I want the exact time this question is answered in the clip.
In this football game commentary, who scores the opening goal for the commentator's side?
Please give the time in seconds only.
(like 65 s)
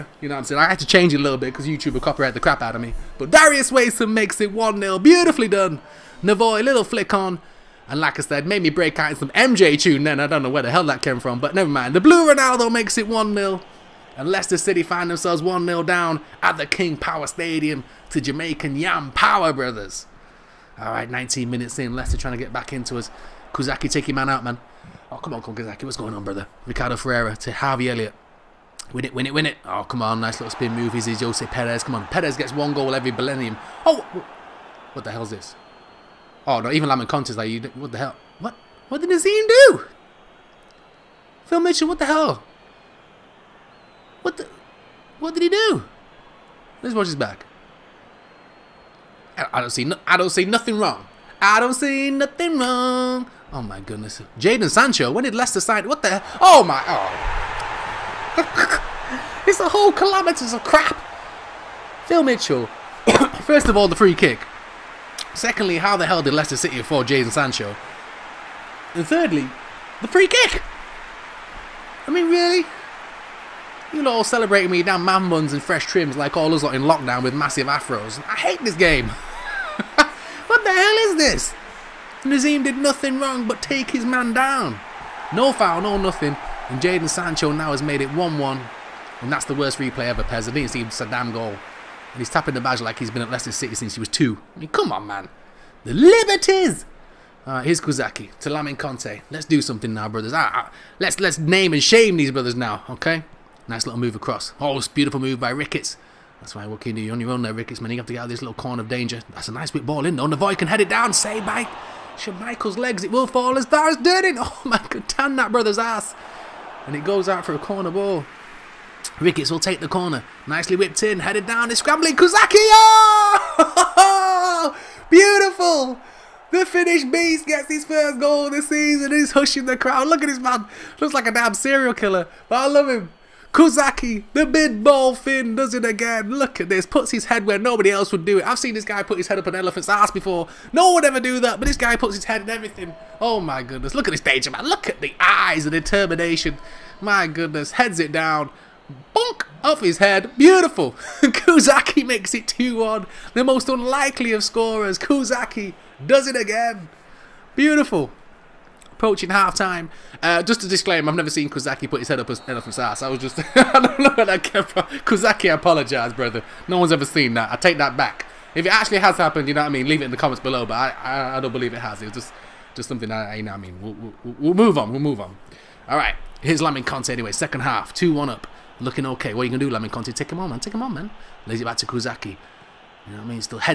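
3 s.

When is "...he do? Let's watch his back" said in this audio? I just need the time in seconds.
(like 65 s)
45 s.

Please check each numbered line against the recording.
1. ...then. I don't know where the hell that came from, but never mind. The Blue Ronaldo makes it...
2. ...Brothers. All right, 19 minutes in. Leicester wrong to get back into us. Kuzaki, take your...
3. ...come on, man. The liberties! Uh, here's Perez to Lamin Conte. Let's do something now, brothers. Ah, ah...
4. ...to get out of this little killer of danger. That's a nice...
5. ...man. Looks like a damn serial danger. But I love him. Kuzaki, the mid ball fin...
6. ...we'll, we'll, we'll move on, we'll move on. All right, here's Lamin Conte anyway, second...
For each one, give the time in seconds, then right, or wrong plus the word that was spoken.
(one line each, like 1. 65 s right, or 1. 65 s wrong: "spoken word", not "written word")
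1. 10 s right
2. 19 s wrong: "trying", not "wrong"
3. 94 s wrong: "Kuzaki", not "Perez"
4. 108 s wrong: "corner", not "killer"
5. 130 s wrong: "killer", not "danger"
6. 173 s right.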